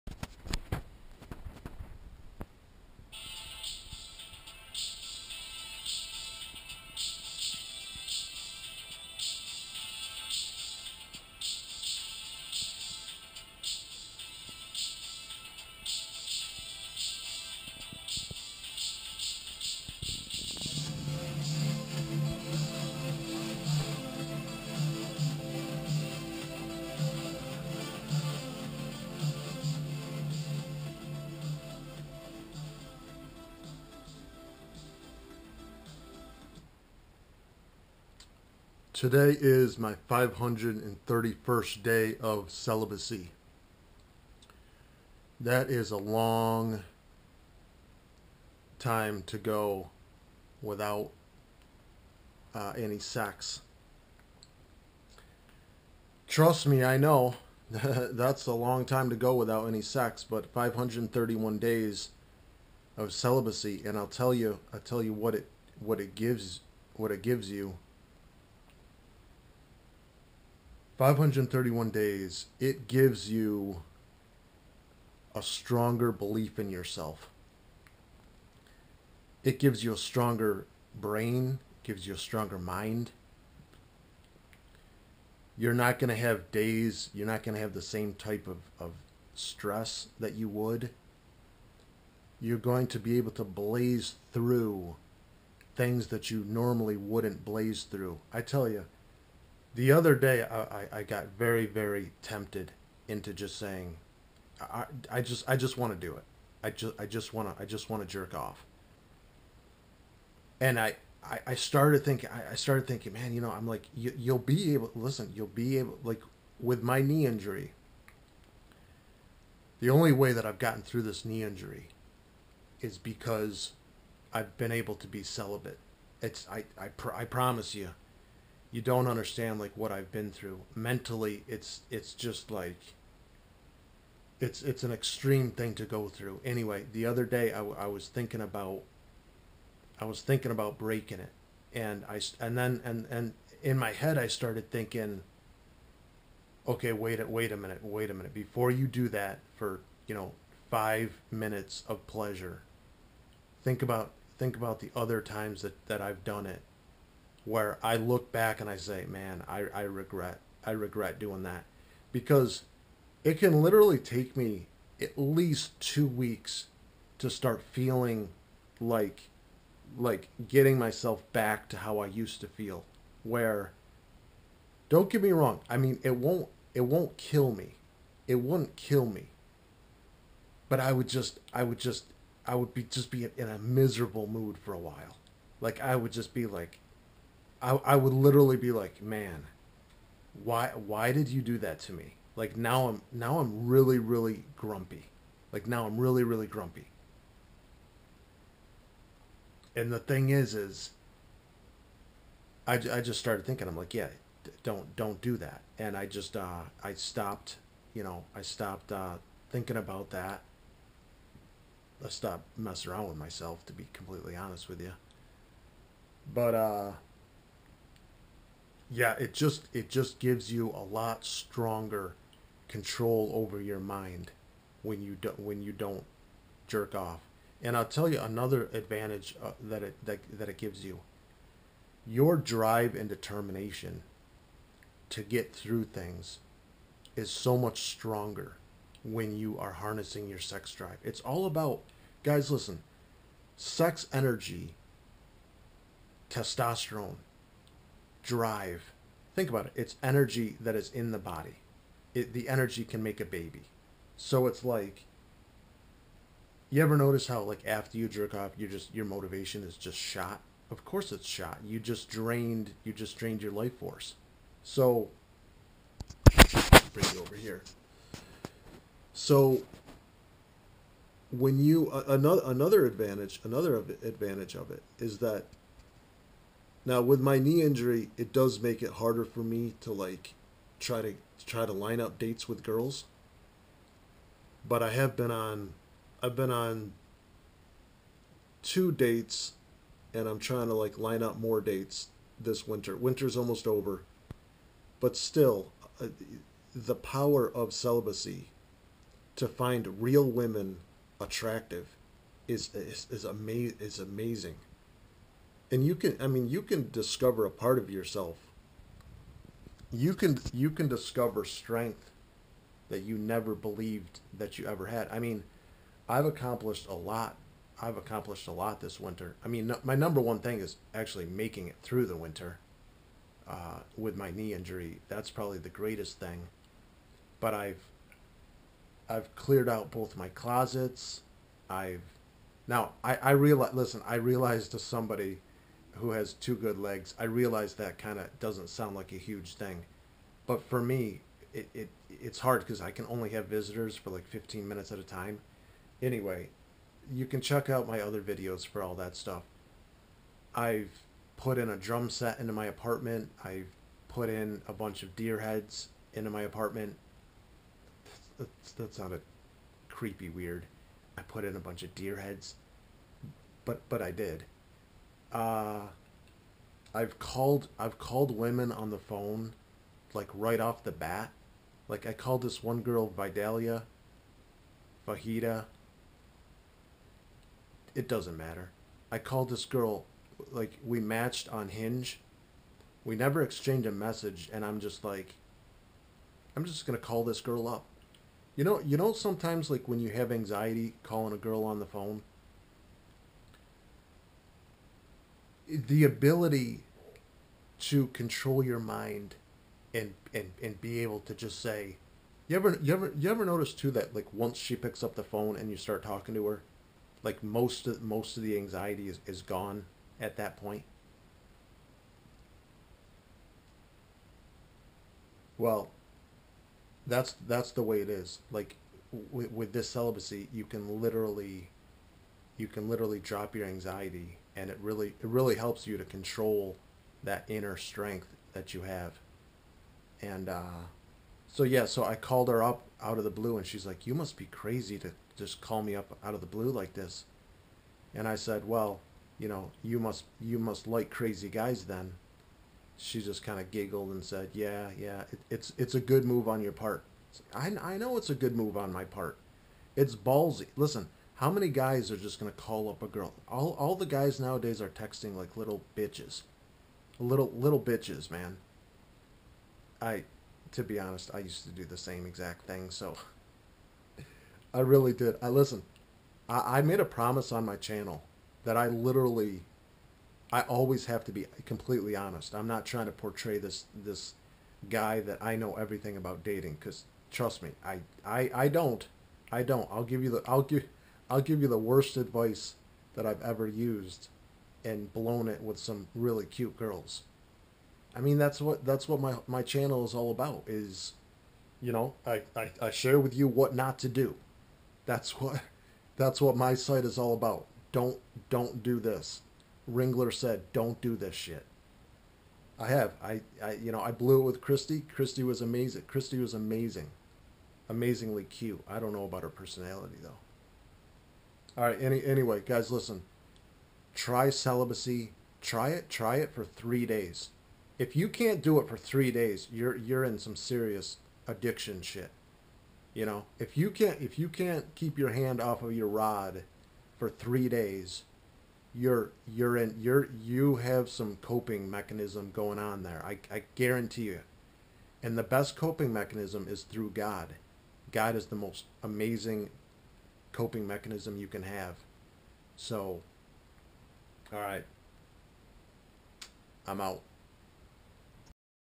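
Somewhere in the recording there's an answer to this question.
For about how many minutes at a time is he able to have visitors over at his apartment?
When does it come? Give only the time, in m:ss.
5:44.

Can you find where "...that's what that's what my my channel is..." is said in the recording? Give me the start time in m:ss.
8:08.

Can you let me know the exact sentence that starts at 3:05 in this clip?
Like I would just be like, I, I would literally be like, man, why why did you do that to me?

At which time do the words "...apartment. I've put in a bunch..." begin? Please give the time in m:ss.
5:52.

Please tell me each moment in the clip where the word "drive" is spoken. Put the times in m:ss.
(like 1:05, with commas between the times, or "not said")
3:52, 4:00, 4:08.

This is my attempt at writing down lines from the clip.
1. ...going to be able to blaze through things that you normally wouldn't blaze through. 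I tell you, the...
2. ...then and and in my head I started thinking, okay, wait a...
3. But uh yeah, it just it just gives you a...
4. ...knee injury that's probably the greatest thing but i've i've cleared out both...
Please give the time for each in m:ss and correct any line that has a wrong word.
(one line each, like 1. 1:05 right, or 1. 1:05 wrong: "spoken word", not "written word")
1. 1:32 right
2. 2:22 right
3. 3:36 right
4. 5:24 right.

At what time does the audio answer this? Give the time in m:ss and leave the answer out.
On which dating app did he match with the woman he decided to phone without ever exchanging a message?
6:21.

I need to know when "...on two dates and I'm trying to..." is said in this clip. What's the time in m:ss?
4:46.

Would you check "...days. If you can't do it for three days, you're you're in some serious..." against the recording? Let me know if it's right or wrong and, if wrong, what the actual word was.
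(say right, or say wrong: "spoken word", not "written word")
right.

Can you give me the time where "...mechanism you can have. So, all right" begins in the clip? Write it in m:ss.
9:00.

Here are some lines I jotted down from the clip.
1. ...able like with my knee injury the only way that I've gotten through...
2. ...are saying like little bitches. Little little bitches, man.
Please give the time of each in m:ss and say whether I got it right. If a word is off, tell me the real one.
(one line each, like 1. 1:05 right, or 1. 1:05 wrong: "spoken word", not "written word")
1. 1:55 right
2. 7:34 wrong: "texting", not "saying".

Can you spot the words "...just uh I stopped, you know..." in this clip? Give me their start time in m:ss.
3:26.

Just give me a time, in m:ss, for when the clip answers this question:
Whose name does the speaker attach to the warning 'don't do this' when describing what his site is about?
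8:19.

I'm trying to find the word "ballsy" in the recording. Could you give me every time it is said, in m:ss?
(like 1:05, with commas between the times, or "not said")
7:30.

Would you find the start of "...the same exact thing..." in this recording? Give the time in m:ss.
7:41.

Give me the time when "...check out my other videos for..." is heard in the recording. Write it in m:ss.
5:47.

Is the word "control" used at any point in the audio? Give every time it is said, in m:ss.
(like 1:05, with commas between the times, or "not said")
3:42, 6:38, 7:06.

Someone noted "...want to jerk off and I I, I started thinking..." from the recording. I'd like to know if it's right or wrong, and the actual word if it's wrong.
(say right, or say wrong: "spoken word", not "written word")
right.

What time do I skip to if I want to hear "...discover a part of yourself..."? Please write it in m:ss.
5:06.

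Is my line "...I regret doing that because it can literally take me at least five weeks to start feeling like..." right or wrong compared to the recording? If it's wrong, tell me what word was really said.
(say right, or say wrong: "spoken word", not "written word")
wrong: "two", not "five".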